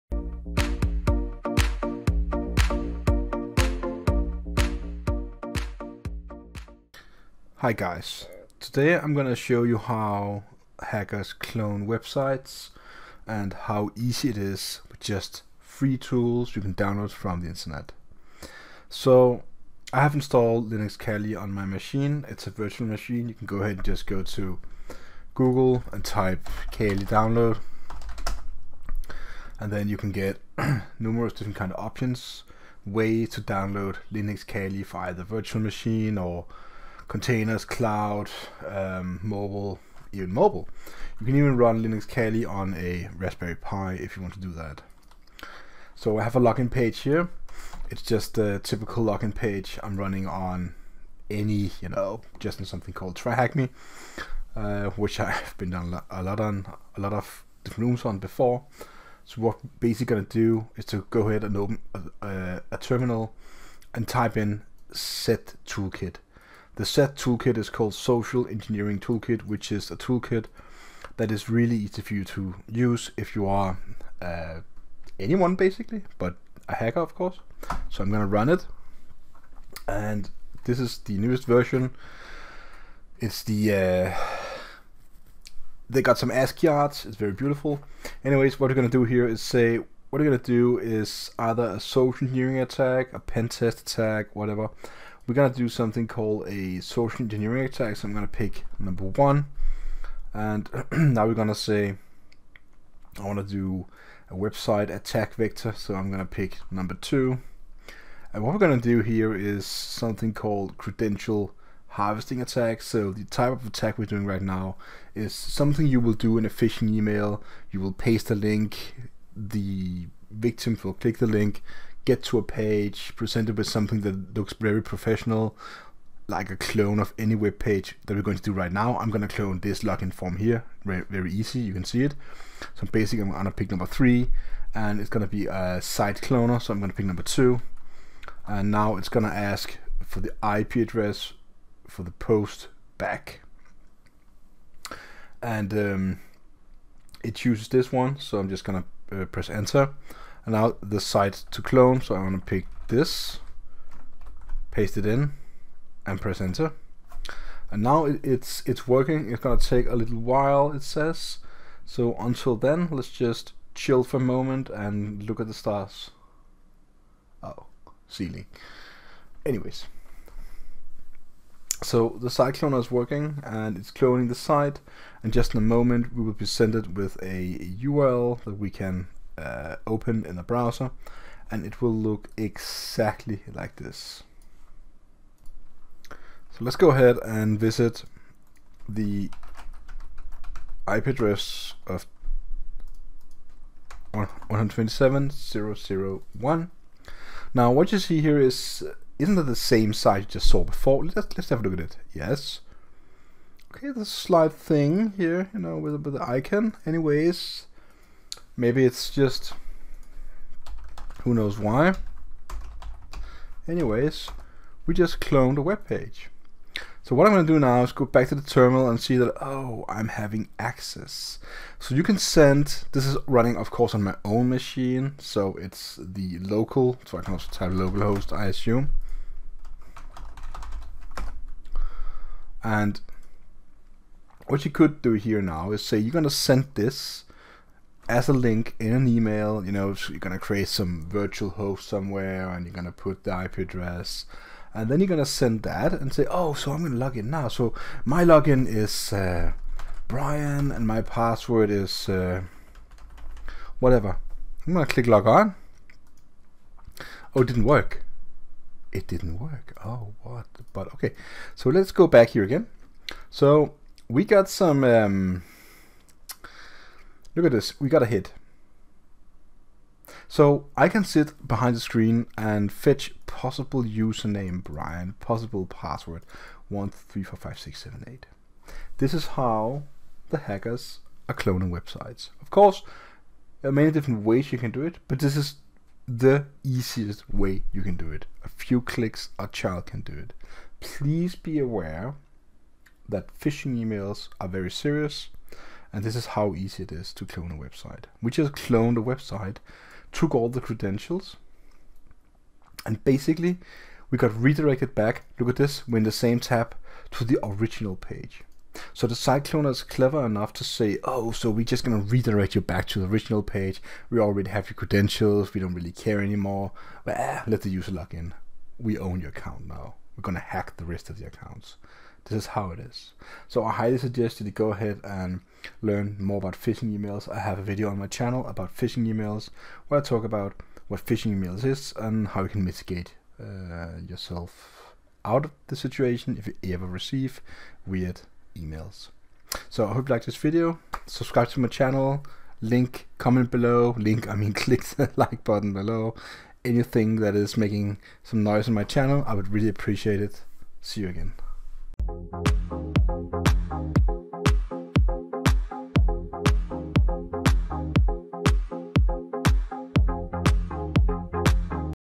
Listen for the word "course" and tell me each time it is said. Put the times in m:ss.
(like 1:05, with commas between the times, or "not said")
1:17, 3:43, 4:42.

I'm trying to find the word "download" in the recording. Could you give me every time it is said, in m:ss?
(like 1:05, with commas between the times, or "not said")
0:16, 0:27, 0:33.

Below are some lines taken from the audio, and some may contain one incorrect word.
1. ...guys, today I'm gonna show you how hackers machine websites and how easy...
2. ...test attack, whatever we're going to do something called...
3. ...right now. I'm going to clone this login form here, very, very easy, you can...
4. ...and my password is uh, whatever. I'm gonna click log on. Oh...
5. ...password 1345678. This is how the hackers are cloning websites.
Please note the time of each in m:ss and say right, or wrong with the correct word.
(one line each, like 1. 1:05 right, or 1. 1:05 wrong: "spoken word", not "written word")
1. 0:07 wrong: "clone", not "machine"
2. 1:33 right
3. 2:08 right
4. 4:10 right
5. 4:35 right.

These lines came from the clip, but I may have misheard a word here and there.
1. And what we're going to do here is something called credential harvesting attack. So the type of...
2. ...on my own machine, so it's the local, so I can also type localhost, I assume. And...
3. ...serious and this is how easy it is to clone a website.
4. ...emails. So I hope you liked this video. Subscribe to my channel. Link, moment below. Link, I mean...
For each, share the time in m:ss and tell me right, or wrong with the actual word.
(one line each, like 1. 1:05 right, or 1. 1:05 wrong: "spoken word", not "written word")
1. 1:48 right
2. 3:43 right
3. 4:54 right
4. 5:38 wrong: "comment", not "moment".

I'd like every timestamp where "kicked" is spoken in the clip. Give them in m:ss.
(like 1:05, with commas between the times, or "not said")
not said.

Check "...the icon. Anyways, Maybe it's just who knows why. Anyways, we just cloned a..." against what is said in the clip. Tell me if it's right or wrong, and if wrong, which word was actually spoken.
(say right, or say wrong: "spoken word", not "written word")
right.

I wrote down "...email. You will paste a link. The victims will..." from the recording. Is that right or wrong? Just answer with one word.
right.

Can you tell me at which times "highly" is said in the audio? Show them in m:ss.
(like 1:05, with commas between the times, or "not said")
5:23.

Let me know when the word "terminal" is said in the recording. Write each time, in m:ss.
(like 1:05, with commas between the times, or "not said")
1:02, 3:38.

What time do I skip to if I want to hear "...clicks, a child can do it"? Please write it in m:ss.
4:48.